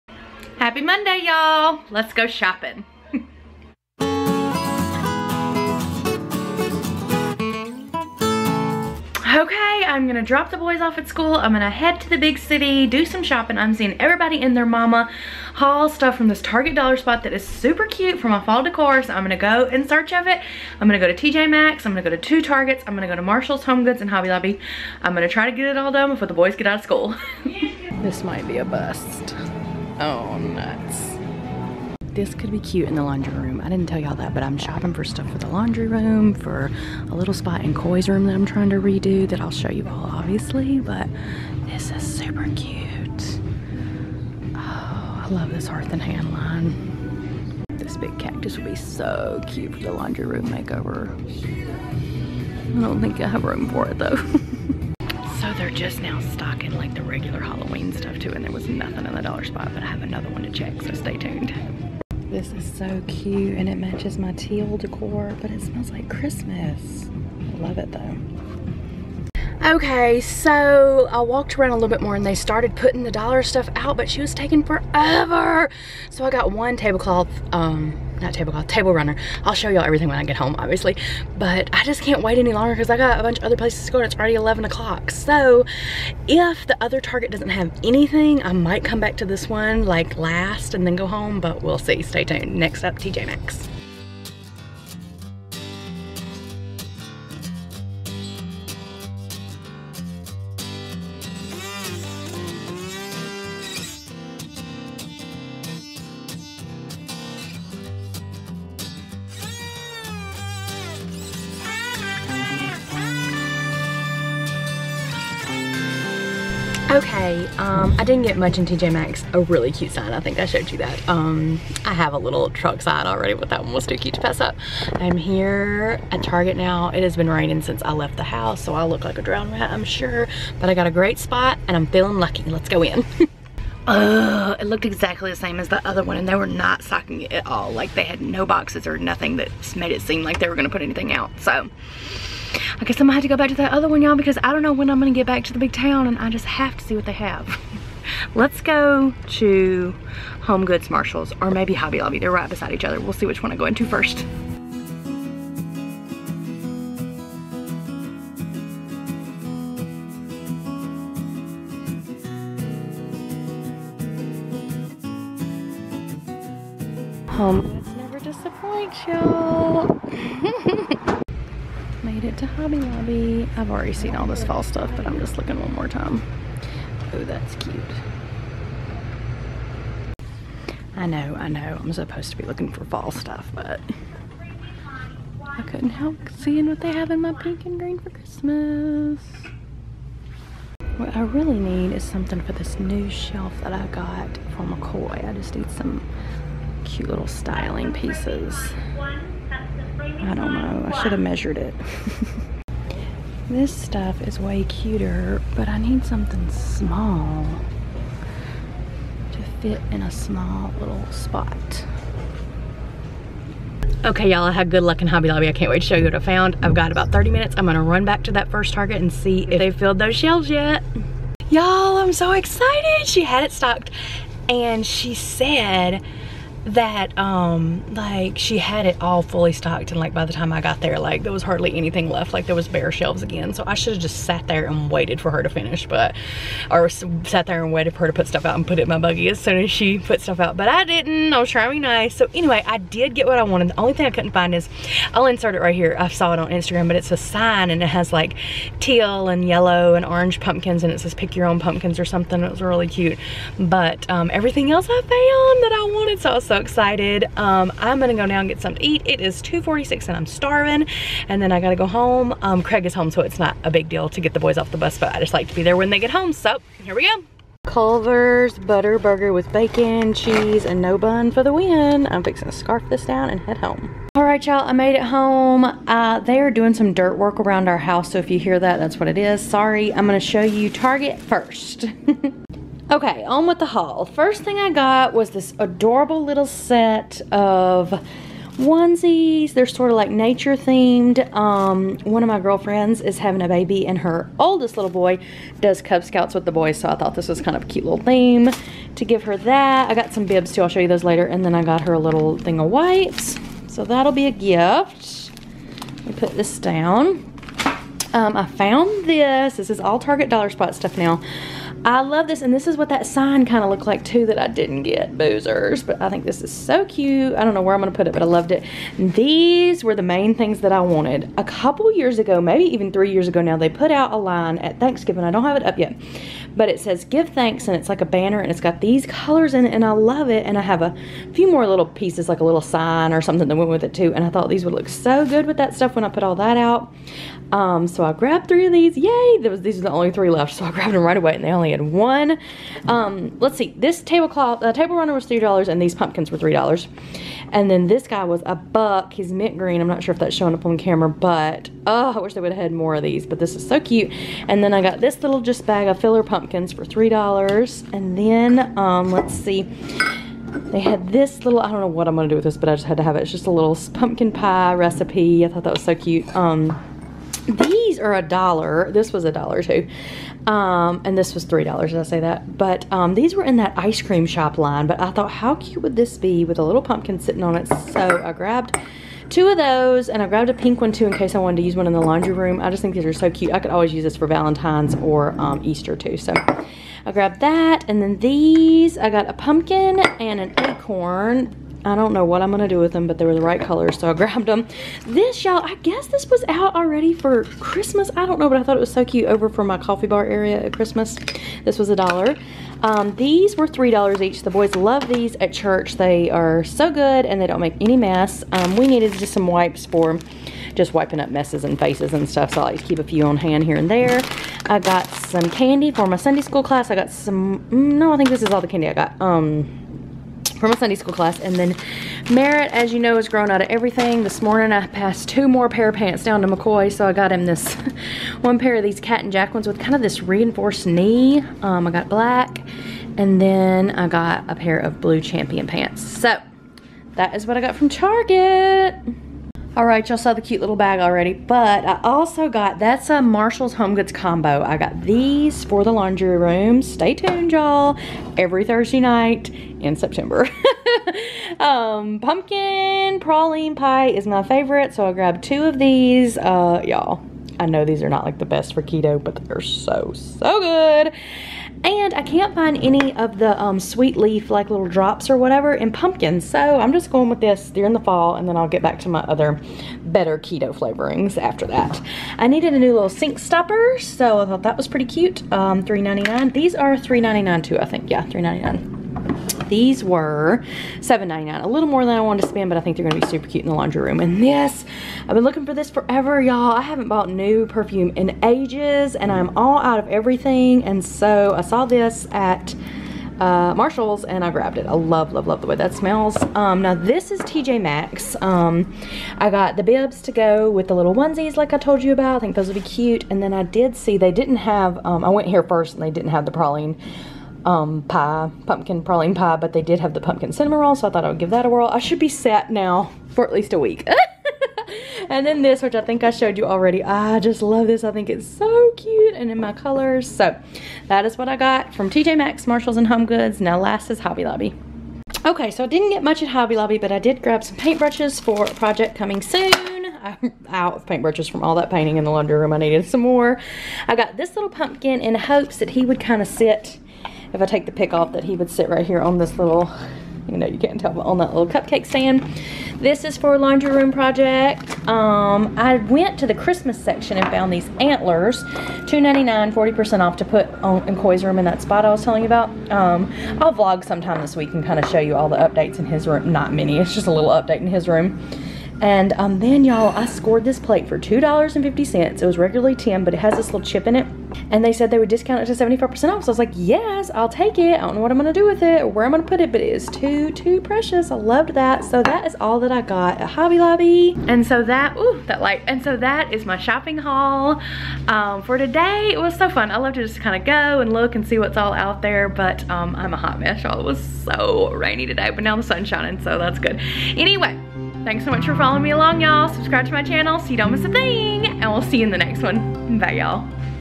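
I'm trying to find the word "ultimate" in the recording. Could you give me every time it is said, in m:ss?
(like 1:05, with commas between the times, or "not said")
not said.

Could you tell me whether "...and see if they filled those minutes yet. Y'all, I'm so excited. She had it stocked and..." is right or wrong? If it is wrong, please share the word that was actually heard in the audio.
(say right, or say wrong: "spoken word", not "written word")
wrong: "shelves", not "minutes".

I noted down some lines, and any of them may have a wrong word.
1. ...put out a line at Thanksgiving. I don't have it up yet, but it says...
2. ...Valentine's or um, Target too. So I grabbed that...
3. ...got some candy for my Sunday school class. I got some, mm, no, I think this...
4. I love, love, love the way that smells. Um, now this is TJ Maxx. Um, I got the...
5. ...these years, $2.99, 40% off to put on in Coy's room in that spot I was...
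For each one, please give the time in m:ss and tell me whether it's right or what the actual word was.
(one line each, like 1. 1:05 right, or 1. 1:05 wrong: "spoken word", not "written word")
1. 5:23 right
2. 6:24 wrong: "Easter", not "Target"
3. 6:54 right
4. 8:14 right
5. 9:07 wrong: "antlers", not "years".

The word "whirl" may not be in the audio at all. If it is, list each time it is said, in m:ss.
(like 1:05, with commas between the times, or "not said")
8:31.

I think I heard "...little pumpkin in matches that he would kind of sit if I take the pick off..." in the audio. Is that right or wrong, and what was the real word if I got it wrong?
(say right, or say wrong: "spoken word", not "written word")
wrong: "hopes", not "matches".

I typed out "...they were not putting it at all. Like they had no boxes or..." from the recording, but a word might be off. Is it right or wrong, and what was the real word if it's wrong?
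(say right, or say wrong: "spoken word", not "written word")
wrong: "stocking", not "putting".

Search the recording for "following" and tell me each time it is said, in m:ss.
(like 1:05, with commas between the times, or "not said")
9:48.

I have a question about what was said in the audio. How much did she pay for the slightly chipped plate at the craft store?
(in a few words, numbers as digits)
$2.50.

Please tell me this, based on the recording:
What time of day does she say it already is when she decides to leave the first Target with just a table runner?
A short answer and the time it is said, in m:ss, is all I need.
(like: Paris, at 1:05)
11 o'clock, at 1:24.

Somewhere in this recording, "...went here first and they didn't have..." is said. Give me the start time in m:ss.
8:25.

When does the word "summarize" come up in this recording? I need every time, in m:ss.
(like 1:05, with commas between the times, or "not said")
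not said.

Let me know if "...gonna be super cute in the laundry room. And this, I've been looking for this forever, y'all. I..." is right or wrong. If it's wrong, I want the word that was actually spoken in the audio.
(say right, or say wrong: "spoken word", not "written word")
right.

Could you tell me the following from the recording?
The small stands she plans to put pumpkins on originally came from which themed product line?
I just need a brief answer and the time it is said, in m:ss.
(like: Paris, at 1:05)
ice cream shop, at 6:13.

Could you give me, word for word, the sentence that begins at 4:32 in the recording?
I'm fixing to scarf this down and head home.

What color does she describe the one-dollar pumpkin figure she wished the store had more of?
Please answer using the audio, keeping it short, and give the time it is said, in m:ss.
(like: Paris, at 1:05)
mint green, at 5:49.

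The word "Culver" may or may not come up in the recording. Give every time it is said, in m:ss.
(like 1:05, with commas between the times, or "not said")
4:27.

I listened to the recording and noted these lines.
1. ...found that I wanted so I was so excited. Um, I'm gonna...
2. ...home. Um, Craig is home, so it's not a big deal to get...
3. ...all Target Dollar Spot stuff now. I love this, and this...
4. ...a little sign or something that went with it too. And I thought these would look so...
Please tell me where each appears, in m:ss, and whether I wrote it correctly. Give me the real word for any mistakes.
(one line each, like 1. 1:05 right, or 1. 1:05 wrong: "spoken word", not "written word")
1. 4:15 right
2. 4:21 right
3. 5:09 right
4. 5:32 right.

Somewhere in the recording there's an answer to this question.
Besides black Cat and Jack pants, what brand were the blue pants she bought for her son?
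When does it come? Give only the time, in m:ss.
7:15.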